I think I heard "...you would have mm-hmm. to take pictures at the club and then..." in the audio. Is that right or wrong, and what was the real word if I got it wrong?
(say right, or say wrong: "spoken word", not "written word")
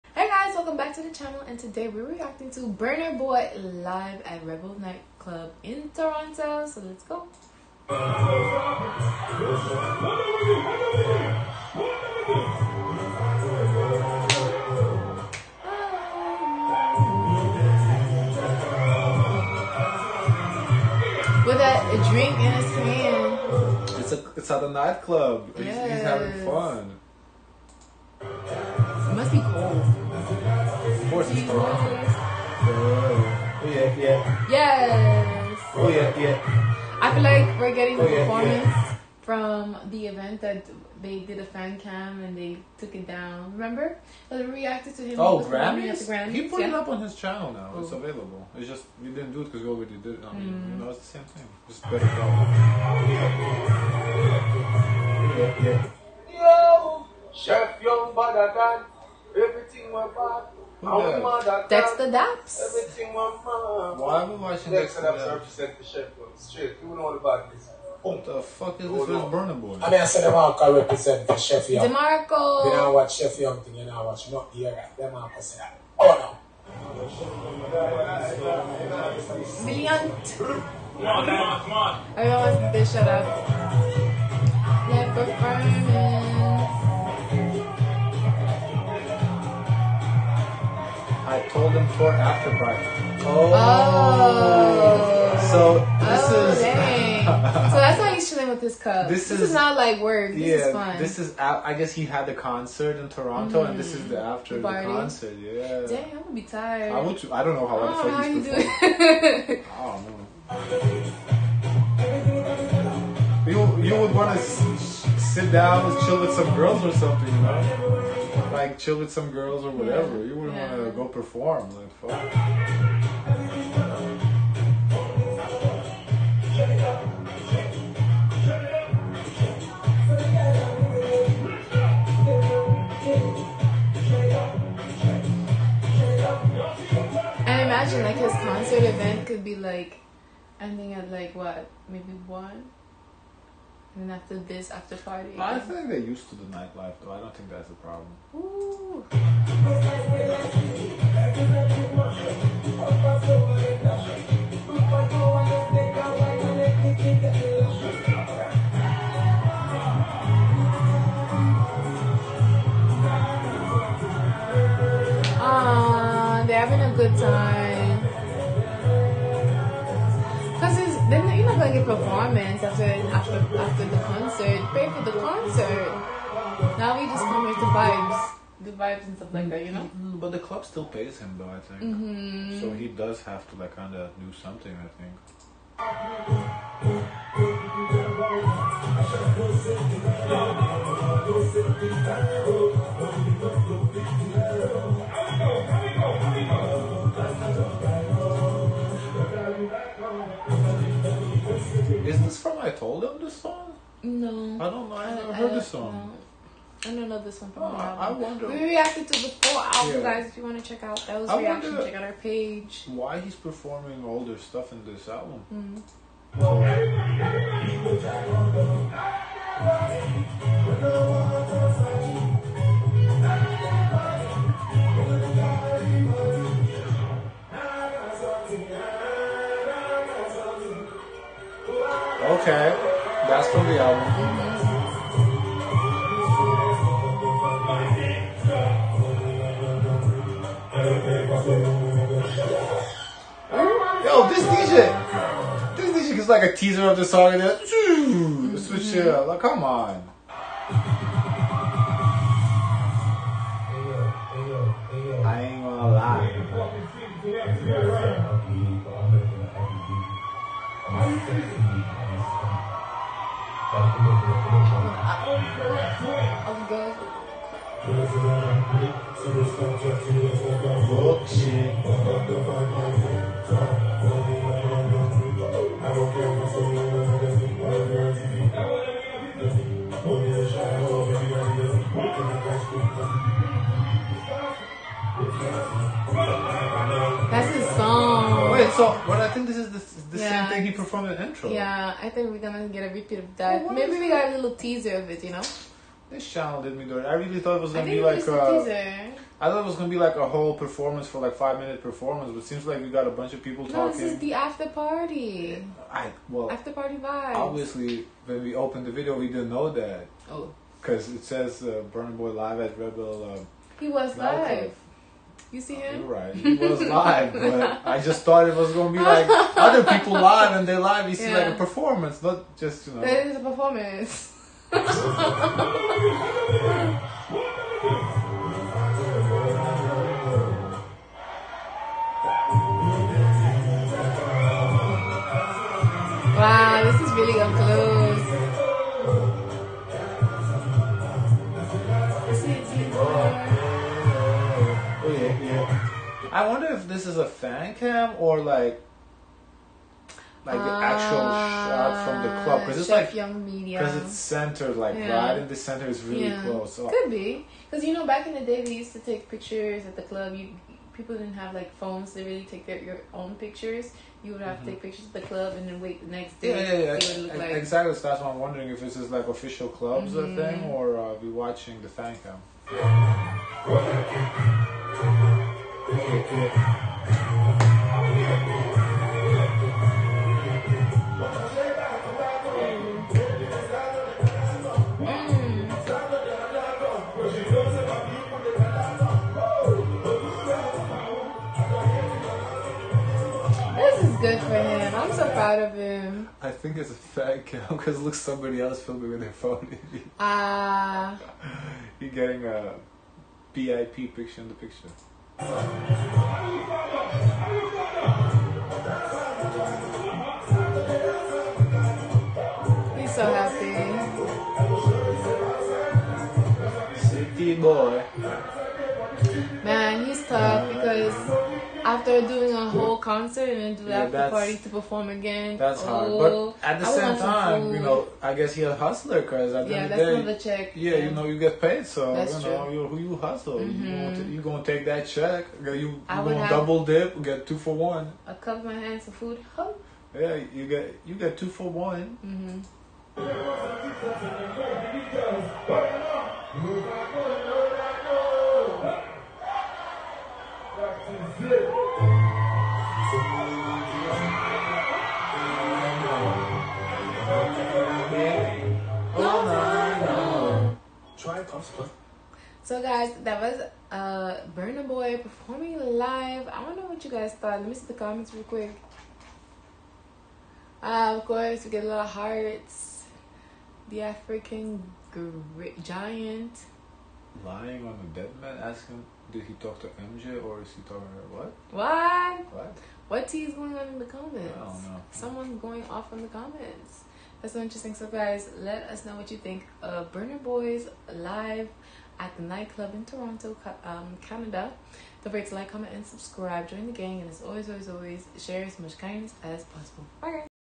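right.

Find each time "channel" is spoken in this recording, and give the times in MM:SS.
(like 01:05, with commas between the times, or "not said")
00:01, 00:47, 04:56.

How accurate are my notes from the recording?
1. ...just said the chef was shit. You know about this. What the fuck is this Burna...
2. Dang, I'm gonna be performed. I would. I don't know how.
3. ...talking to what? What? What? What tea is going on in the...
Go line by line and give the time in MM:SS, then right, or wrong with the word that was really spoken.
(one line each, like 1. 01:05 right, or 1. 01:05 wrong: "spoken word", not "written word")
1. 01:05 right
2. 01:45 wrong: "tired", not "performed"
3. 08:00 right.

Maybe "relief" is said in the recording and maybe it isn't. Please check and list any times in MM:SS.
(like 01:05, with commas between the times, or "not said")
not said.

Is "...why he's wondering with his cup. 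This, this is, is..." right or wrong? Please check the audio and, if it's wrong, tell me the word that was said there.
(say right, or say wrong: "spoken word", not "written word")
wrong: "chilling", not "wondering".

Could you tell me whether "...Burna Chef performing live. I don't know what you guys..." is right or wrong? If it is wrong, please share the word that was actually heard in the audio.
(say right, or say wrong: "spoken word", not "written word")
wrong: "Boy", not "Chef".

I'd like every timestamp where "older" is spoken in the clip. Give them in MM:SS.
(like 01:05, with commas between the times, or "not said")
03:34.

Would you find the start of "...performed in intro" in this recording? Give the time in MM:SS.
04:50.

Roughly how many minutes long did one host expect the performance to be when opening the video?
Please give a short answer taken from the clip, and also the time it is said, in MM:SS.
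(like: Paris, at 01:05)
5 minutes, at 05:01.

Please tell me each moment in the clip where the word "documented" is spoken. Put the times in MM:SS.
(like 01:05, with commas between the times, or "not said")
not said.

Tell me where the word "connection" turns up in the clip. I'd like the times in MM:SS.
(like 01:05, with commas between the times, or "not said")
not said.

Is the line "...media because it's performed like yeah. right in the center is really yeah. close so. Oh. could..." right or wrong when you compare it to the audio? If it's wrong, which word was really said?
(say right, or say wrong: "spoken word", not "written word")
wrong: "centered", not "performed".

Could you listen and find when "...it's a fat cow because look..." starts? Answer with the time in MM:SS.
06:36.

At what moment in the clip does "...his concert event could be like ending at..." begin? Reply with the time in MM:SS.
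02:18.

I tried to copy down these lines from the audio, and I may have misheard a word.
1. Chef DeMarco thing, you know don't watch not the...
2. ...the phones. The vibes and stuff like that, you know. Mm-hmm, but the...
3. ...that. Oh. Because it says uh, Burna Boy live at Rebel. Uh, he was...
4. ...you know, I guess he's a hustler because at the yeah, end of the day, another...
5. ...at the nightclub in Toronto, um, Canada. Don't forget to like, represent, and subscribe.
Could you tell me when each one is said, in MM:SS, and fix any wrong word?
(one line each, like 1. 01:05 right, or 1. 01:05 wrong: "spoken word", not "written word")
1. 01:13 wrong: "Young", not "DeMarco"
2. 02:57 wrong: "vibes", not "phones"
3. 05:09 right
4. 07:07 right
5. 08:12 wrong: "comment", not "represent".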